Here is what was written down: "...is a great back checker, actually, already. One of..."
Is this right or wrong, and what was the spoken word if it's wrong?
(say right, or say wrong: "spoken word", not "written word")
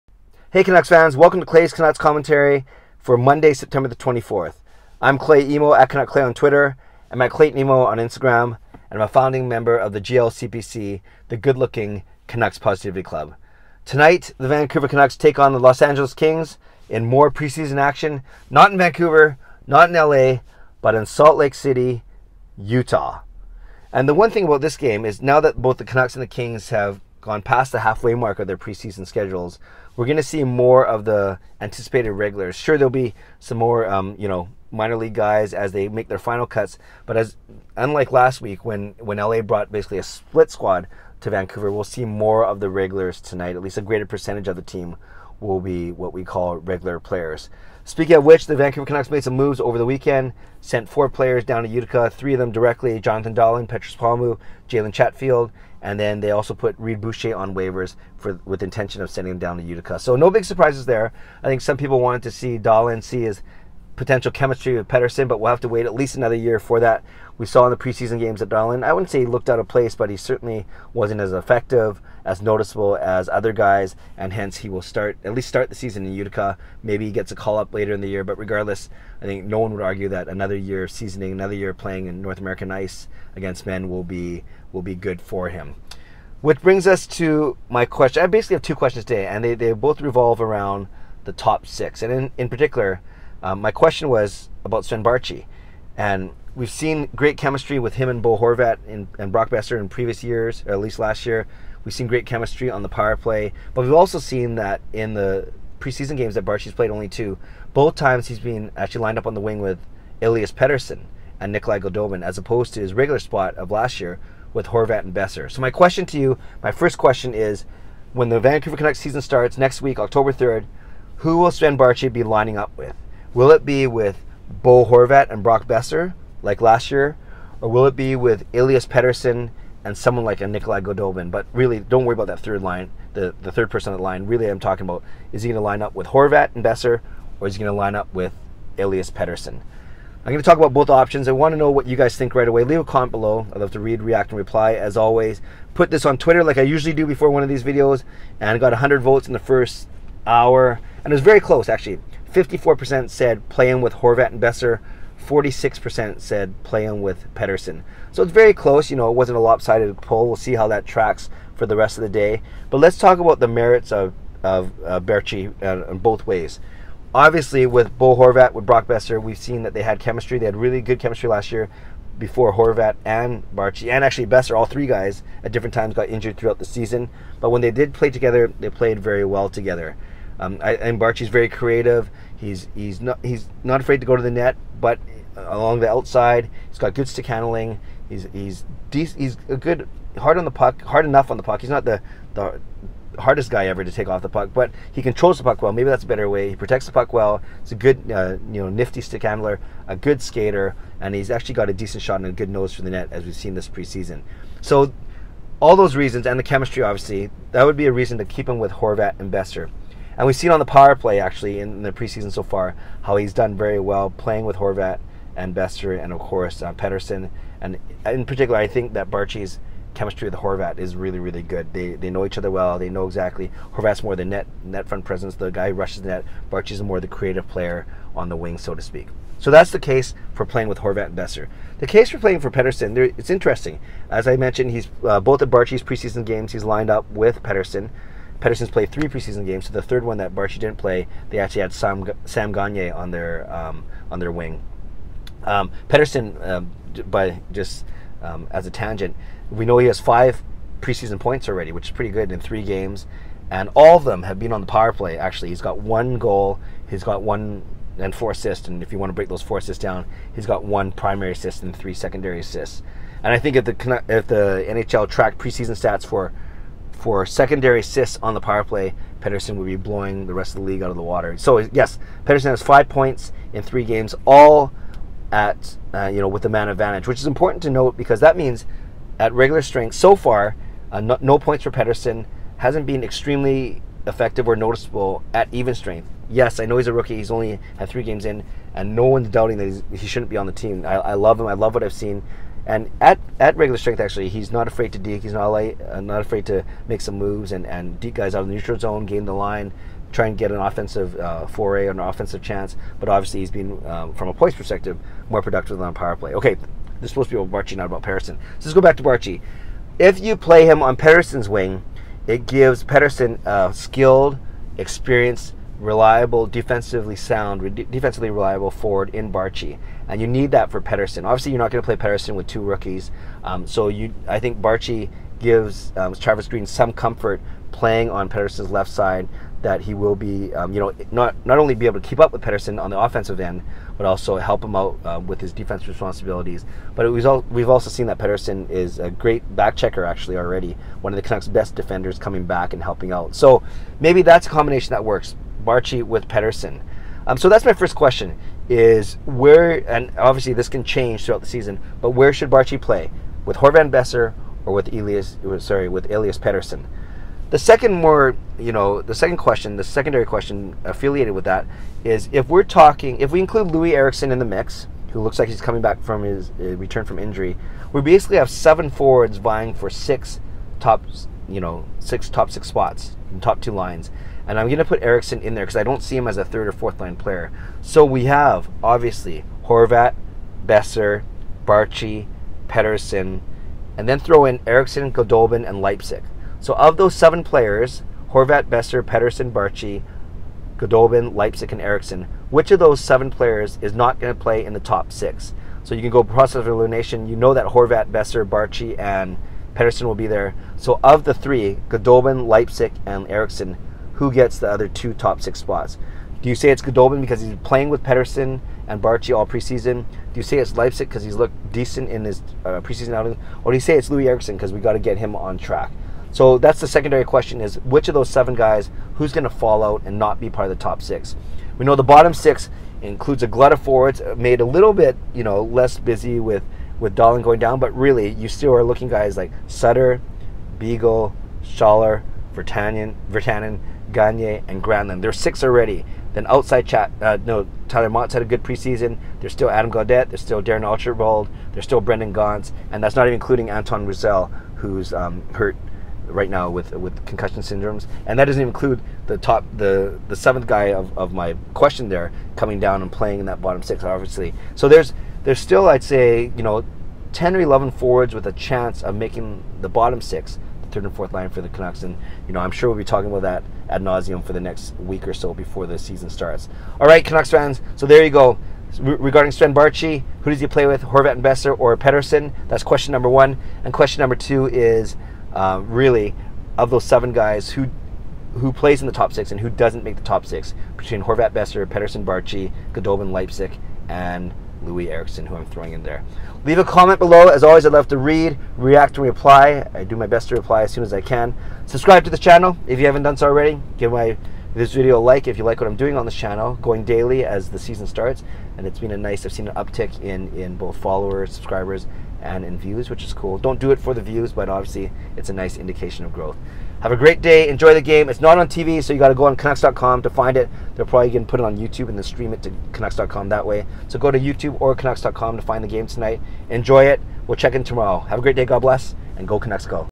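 right.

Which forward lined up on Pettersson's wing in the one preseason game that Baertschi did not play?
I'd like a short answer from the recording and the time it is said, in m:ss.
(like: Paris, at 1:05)
Sam Gagner, at 4:02.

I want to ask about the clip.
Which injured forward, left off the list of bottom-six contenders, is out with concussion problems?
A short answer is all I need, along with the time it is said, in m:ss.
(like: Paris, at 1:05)
Antoine Roussel, at 7:23.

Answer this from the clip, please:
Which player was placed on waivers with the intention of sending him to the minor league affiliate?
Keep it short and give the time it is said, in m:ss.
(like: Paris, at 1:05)
Reed Boucher, at 0:56.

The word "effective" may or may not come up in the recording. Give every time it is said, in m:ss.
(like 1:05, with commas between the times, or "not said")
1:11, 4:44.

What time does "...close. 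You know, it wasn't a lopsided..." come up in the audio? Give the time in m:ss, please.
2:38.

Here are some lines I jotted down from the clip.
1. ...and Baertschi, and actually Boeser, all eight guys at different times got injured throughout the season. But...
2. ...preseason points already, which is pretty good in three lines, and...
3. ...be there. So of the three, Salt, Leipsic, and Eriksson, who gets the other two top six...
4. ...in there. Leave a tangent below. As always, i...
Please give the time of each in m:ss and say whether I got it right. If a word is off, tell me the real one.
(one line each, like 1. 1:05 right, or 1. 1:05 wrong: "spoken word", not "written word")
1. 2:53 wrong: "three", not "eight"
2. 4:10 wrong: "games", not "lines"
3. 6:40 wrong: "Goldobin", not "Salt"
4. 8:05 wrong: "comment", not "tangent".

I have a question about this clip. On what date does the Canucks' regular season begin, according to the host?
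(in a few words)
October 3rd.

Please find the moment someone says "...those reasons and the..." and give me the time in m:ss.
3:25.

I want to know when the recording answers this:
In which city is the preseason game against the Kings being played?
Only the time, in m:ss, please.
0:21.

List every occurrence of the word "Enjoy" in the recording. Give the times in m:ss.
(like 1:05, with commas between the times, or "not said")
8:27, 8:36.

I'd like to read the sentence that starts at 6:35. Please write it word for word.
So you can go process of elimination.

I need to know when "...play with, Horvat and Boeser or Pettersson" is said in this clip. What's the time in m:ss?
7:50.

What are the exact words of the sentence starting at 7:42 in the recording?
And, you know, I'm sure we'll be talking about that ad nauseum for the next week or so before the season starts.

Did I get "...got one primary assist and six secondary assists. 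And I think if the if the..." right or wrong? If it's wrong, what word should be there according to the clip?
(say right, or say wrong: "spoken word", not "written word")
wrong: "three", not "six".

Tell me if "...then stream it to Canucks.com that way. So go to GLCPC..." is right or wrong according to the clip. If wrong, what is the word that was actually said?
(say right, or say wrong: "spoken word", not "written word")
wrong: "YouTube", not "GLCPC".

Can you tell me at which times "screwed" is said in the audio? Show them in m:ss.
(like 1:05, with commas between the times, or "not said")
not said.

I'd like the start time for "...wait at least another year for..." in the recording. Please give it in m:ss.
1:05.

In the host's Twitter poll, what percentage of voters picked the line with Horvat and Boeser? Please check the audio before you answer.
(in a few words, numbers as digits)
54%.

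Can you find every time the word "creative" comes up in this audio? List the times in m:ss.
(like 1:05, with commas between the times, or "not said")
3:01, 3:47.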